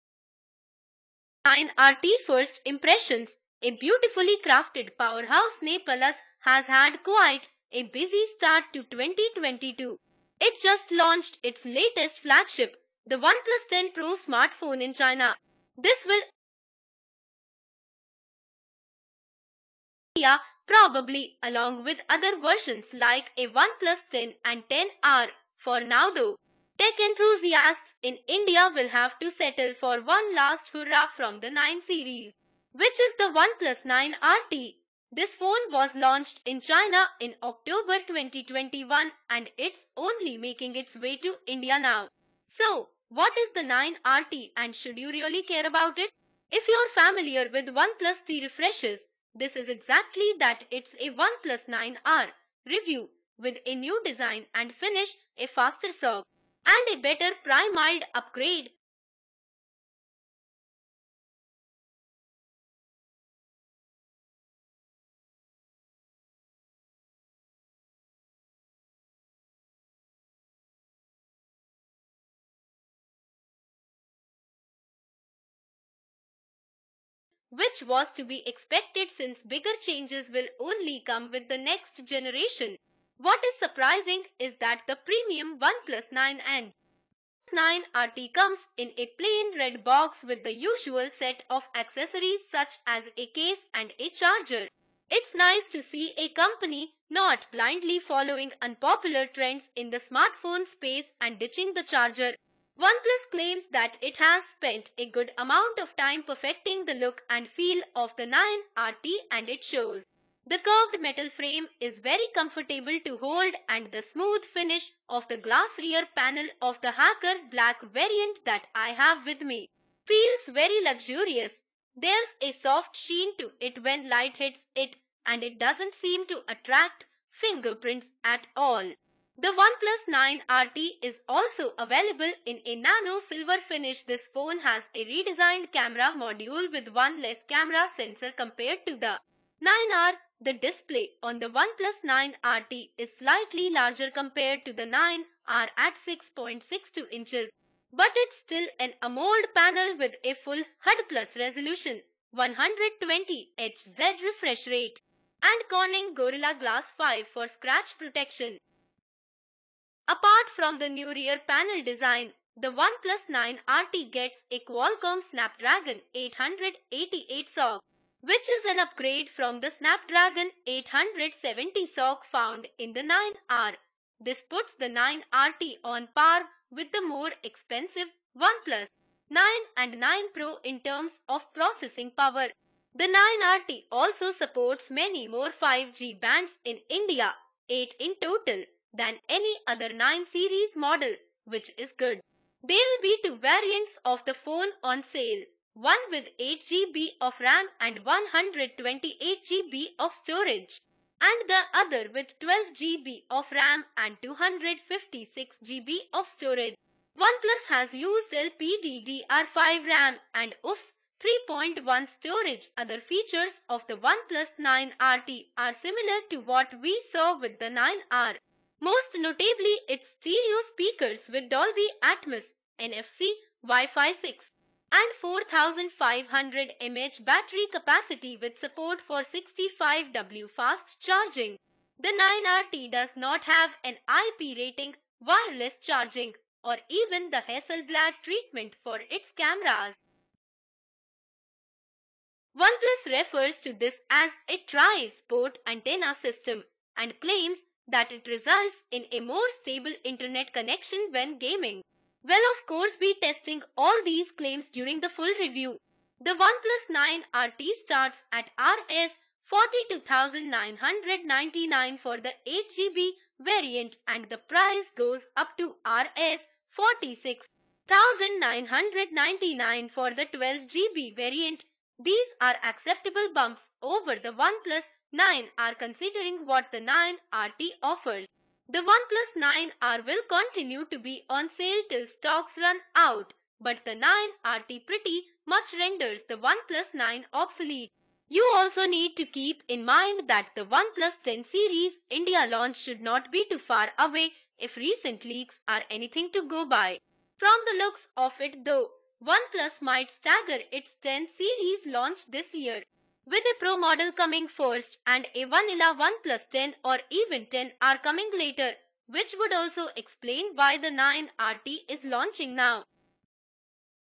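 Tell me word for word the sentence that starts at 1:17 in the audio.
which was to be expected since bigger changes will only come with the next generation.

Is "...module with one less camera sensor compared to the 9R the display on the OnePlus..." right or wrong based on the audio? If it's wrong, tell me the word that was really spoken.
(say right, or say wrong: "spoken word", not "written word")
right.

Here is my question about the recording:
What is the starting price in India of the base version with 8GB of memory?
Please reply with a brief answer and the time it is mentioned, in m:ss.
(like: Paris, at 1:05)
Rs 42,999, at 4:18.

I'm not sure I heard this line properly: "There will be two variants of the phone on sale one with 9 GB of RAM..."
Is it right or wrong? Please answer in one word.
wrong.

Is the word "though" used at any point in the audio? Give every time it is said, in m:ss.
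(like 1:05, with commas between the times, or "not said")
0:26, 4:58.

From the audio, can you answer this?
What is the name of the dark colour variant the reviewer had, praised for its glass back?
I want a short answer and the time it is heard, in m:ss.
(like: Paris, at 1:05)
Hacker black, at 1:56.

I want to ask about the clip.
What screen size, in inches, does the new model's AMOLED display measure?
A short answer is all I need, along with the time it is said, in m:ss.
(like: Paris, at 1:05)
6.62 inches, at 2:26.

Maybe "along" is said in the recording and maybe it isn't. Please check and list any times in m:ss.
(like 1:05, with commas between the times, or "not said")
0:21.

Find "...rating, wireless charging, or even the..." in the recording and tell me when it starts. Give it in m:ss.
3:54.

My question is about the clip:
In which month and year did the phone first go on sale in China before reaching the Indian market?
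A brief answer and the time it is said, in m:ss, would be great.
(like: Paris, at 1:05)
October 2021, at 0:37.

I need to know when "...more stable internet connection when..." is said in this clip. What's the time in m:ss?
4:09.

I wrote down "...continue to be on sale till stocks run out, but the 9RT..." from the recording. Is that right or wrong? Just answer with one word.
right.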